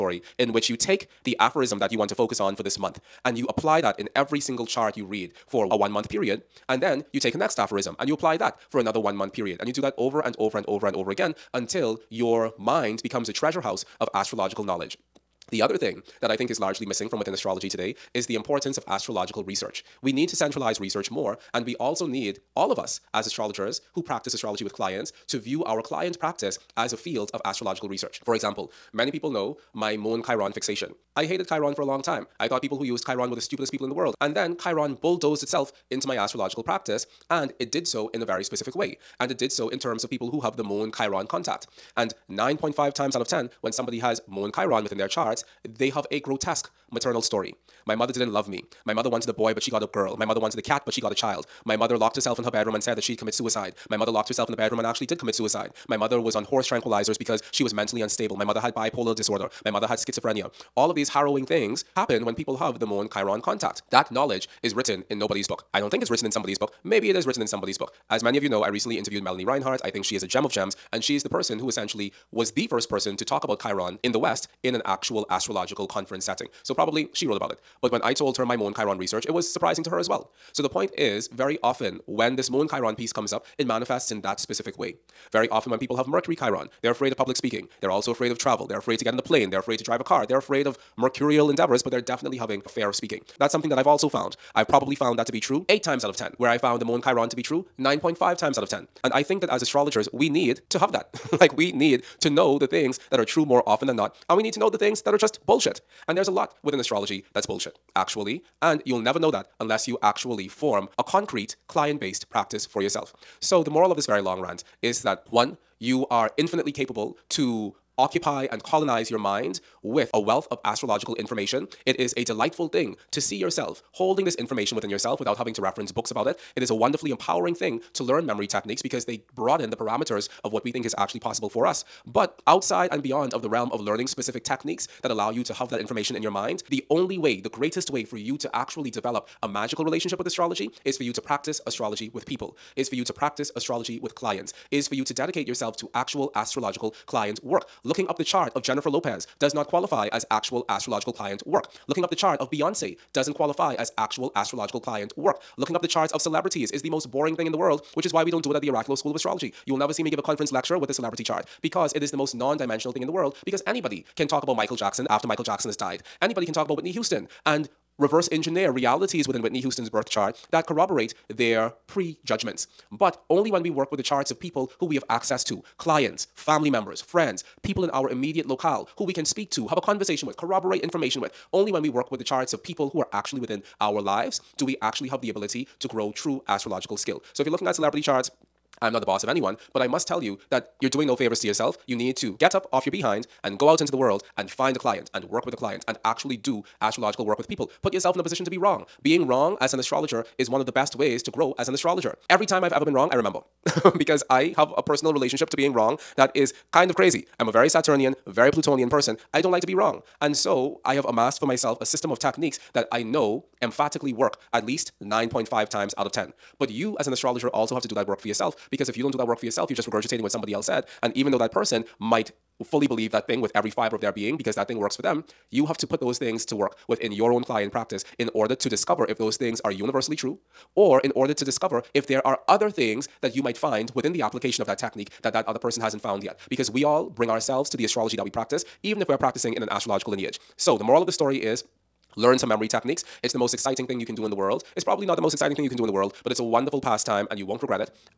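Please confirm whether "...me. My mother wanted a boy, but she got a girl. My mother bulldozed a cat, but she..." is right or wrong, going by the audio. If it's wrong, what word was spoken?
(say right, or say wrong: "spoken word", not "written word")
wrong: "wanted", not "bulldozed".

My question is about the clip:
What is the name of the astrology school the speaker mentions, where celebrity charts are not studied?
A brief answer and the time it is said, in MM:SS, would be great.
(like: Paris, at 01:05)
Oraculos School of Astrology, at 02:38.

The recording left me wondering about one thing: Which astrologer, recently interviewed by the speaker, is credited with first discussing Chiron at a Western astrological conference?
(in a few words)
Melanie Reinhart.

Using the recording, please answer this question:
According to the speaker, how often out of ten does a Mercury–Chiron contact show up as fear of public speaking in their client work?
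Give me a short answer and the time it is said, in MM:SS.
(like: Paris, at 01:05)
8, at 01:35.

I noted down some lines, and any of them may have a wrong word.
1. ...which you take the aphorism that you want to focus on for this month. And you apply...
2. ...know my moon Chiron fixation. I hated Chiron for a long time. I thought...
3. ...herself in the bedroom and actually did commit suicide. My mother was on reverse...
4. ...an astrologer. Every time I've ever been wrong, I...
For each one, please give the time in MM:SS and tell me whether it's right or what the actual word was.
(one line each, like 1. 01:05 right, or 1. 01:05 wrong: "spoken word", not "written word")
1. 00:00 right
2. 00:29 right
3. 00:54 wrong: "horse", not "reverse"
4. 03:21 right.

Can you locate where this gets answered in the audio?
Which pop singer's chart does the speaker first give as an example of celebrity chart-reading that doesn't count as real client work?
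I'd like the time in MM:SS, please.
02:28.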